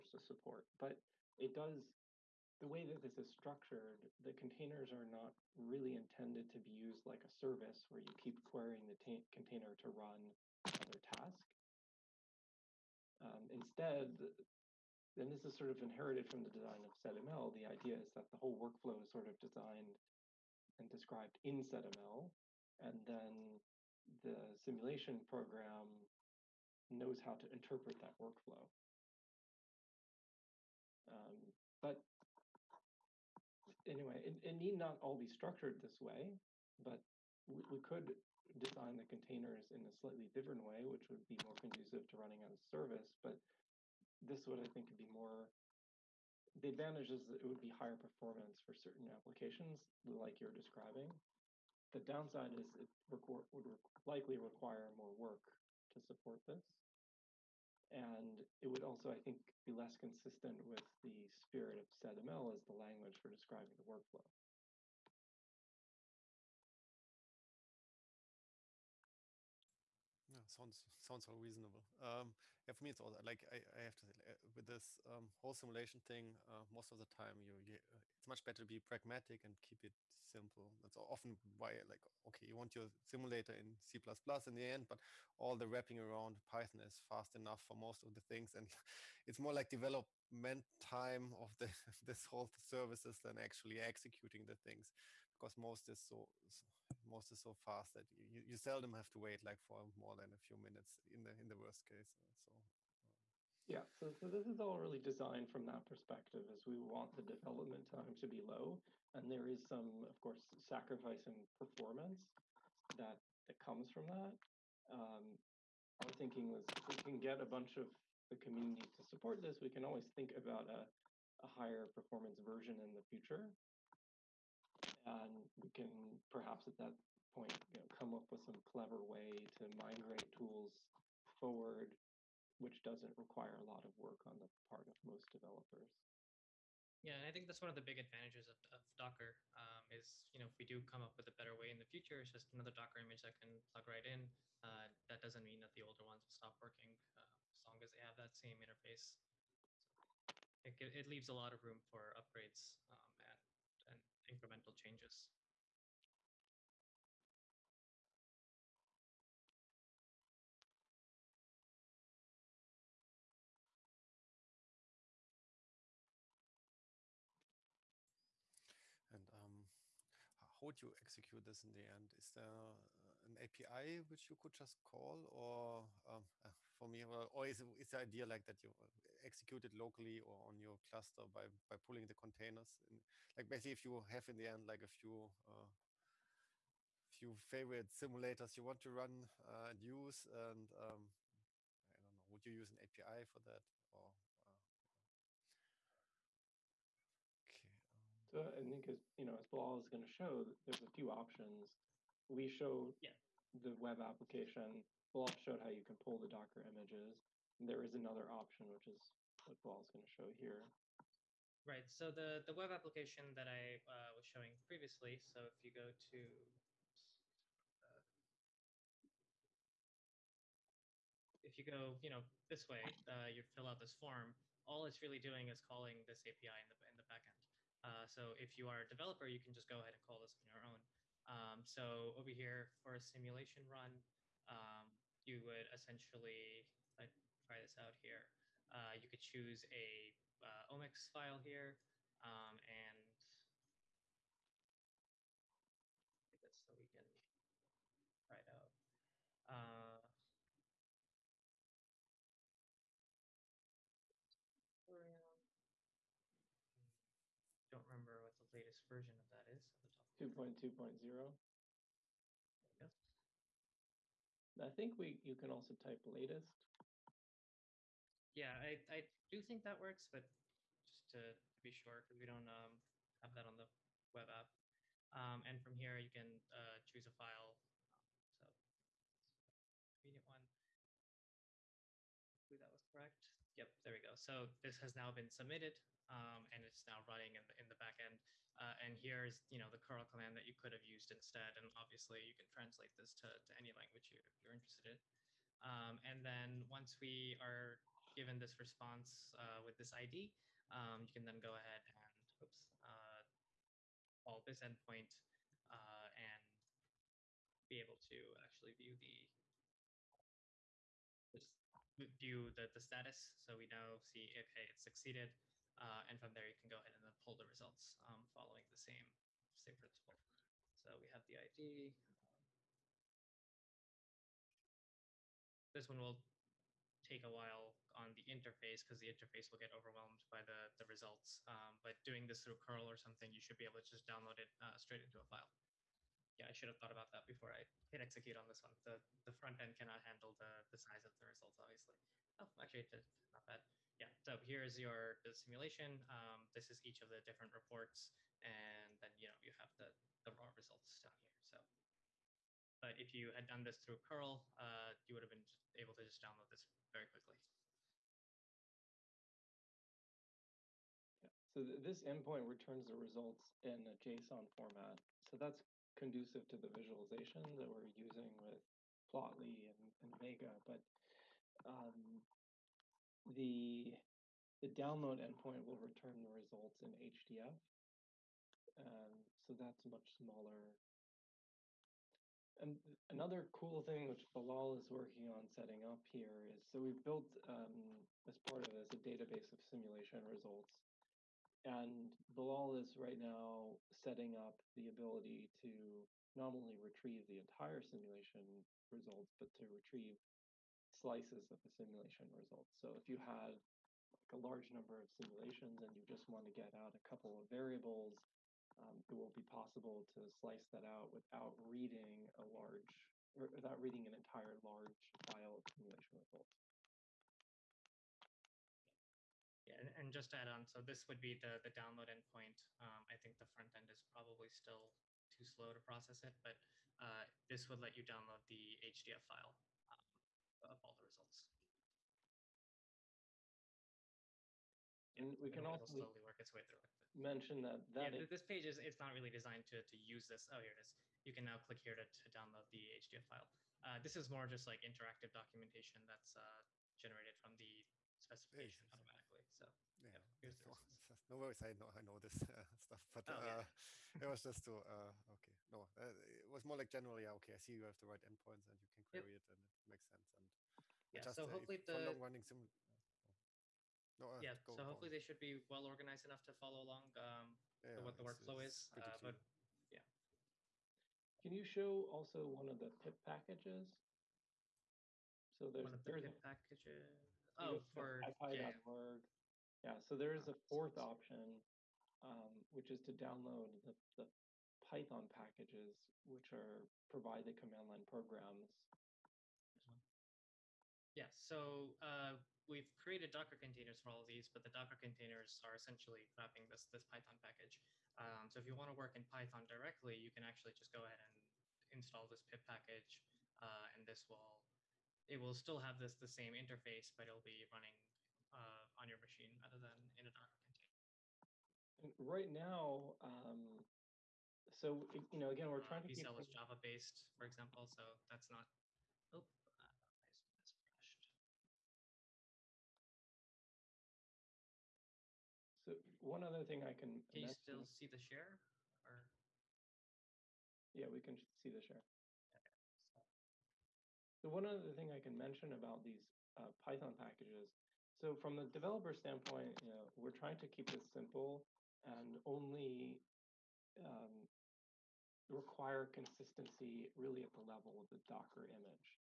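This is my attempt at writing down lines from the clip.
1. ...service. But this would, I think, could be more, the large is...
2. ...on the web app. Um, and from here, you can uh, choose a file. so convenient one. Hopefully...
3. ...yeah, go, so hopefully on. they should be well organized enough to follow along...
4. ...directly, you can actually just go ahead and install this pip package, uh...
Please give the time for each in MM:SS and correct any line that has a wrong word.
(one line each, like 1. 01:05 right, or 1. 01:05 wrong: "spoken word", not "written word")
1. 00:42 wrong: "advantage", not "large"
2. 04:33 right
3. 07:44 right
4. 08:19 right.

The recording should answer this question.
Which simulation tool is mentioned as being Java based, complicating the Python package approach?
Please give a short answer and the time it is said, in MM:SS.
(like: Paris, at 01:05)
VCell, at 08:36.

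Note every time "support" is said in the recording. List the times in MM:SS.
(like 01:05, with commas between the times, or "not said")
00:00, 00:55, 01:59.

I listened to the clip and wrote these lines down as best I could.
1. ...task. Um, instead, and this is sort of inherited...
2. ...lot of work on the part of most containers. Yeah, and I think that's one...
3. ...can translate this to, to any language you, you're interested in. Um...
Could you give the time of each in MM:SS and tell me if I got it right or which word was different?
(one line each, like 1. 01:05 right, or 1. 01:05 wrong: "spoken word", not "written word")
1. 00:10 right
2. 02:13 wrong: "developers", not "containers"
3. 04:52 right.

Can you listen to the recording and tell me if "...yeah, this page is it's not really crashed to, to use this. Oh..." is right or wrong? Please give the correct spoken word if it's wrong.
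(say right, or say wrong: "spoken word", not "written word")
wrong: "designed", not "crashed".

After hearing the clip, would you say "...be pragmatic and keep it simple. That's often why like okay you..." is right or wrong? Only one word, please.
right.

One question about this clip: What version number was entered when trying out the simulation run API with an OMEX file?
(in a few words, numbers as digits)
2.2.0.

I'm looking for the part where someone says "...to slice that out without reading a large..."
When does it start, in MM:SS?
06:50.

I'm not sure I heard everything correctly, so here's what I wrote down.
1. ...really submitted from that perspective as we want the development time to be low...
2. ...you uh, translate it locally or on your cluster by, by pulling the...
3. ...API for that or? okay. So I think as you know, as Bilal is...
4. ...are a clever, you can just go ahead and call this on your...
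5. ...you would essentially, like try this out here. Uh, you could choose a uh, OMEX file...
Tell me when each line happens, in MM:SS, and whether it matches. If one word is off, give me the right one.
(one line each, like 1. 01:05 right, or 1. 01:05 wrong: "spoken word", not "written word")
1. 01:44 wrong: "designed", not "submitted"
2. 02:58 wrong: "execute", not "translate"
3. 03:12 right
4. 03:48 wrong: "developer", not "clever"
5. 03:55 right.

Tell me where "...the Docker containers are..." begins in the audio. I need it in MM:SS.
08:14.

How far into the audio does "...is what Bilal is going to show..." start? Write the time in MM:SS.
03:28.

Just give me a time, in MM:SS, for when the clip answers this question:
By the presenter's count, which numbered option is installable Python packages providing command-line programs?
08:00.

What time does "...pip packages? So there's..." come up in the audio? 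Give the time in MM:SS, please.
07:52.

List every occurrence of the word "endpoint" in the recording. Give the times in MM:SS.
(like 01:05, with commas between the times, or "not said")
05:04, 06:02, 06:15, 07:02, 07:38.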